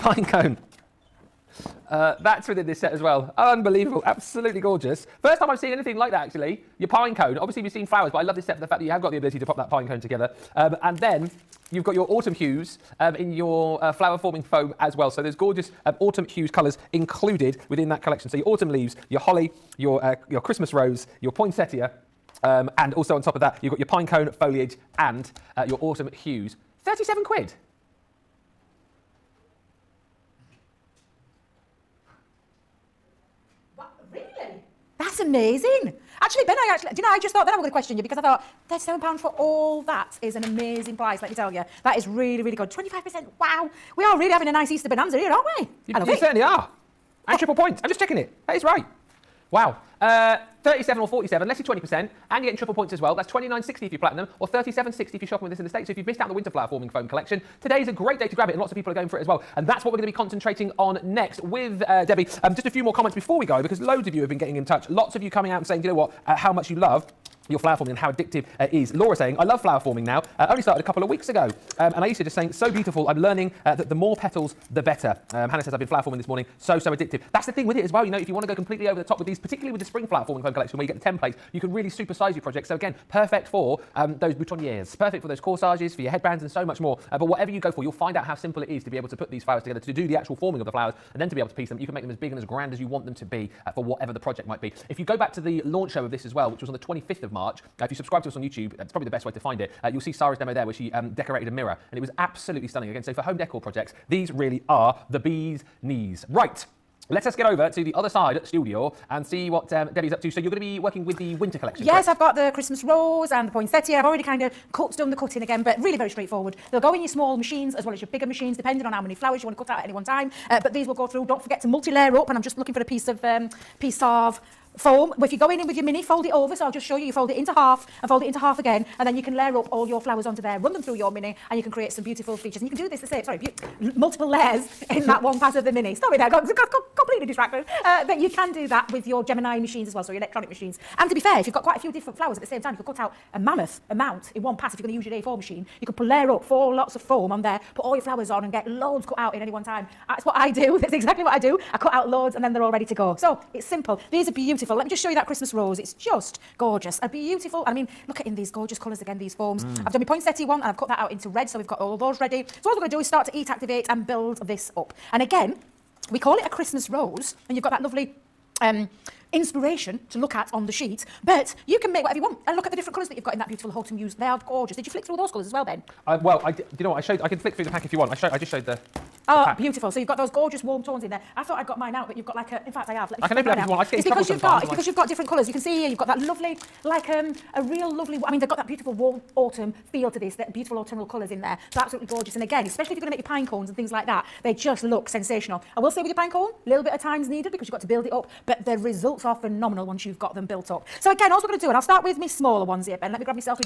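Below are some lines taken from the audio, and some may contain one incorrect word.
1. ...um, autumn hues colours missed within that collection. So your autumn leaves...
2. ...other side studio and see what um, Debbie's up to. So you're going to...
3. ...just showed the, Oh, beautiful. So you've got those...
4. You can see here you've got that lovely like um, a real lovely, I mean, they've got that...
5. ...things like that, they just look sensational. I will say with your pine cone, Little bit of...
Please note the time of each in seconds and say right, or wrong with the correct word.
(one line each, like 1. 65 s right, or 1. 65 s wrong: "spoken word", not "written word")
1. 15 s wrong: "included", not "missed"
2. 107 s right
3. 178 s right
4. 185 s right
5. 193 s right.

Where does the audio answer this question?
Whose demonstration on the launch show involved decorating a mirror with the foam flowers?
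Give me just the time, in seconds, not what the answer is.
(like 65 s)
100 s.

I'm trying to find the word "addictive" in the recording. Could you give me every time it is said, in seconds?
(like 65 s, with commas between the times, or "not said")
68 s, 76 s.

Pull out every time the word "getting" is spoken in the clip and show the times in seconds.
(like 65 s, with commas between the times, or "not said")
52 s, 64 s.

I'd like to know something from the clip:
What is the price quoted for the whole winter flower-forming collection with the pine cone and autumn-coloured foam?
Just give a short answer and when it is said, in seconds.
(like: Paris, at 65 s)
£37, at 26 s.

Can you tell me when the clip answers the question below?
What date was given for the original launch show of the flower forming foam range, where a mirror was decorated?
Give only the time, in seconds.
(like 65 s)
96 s.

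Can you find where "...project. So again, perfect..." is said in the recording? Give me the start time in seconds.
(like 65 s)
82 s.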